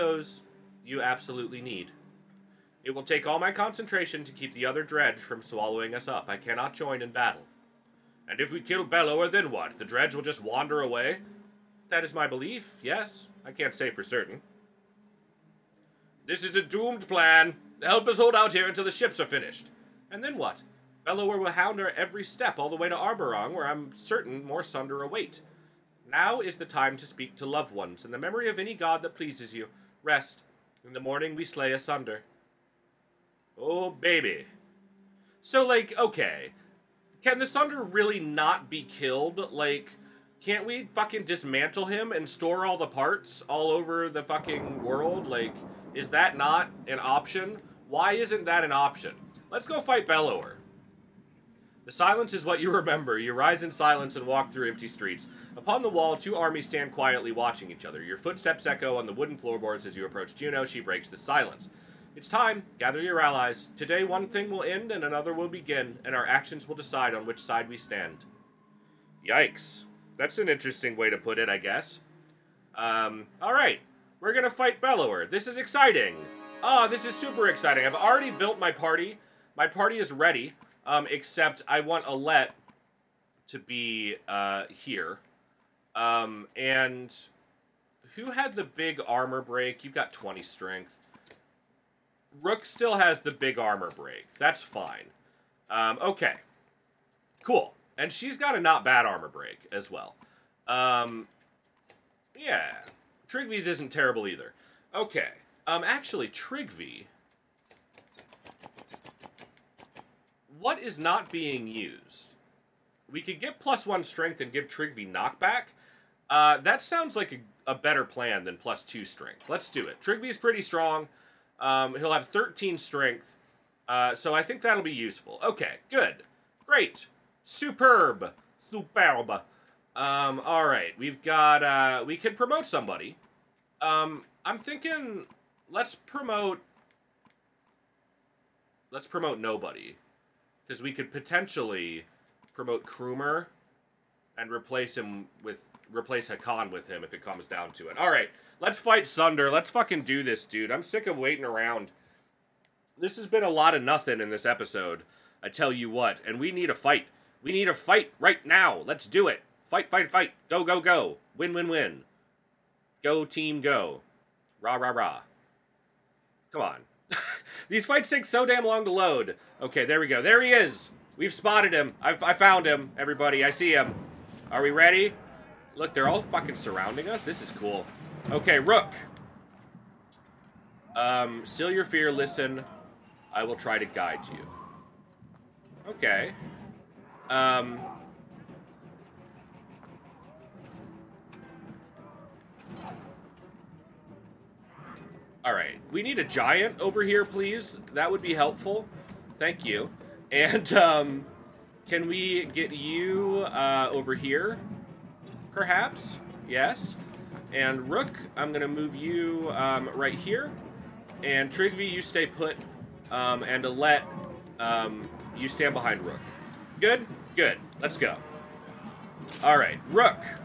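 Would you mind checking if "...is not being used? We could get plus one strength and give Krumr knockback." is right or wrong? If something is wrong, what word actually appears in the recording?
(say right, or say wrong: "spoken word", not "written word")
wrong: "Trigv", not "Krumr".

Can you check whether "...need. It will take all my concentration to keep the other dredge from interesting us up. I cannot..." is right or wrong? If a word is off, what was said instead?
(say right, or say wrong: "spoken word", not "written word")
wrong: "swallowing", not "interesting".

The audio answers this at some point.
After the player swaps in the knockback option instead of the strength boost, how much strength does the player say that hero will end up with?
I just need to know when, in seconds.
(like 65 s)
122 s.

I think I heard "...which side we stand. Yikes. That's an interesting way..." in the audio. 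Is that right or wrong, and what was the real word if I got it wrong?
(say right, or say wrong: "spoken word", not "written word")
right.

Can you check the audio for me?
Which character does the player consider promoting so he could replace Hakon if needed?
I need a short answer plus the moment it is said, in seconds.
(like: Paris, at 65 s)
Krumr, at 142 s.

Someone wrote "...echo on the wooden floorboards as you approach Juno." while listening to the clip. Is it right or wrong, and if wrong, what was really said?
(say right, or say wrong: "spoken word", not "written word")
right.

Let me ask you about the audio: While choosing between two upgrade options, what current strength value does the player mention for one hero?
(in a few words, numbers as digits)
20.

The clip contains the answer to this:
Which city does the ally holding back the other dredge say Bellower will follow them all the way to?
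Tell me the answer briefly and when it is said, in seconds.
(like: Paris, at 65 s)
Arberrang, at 22 s.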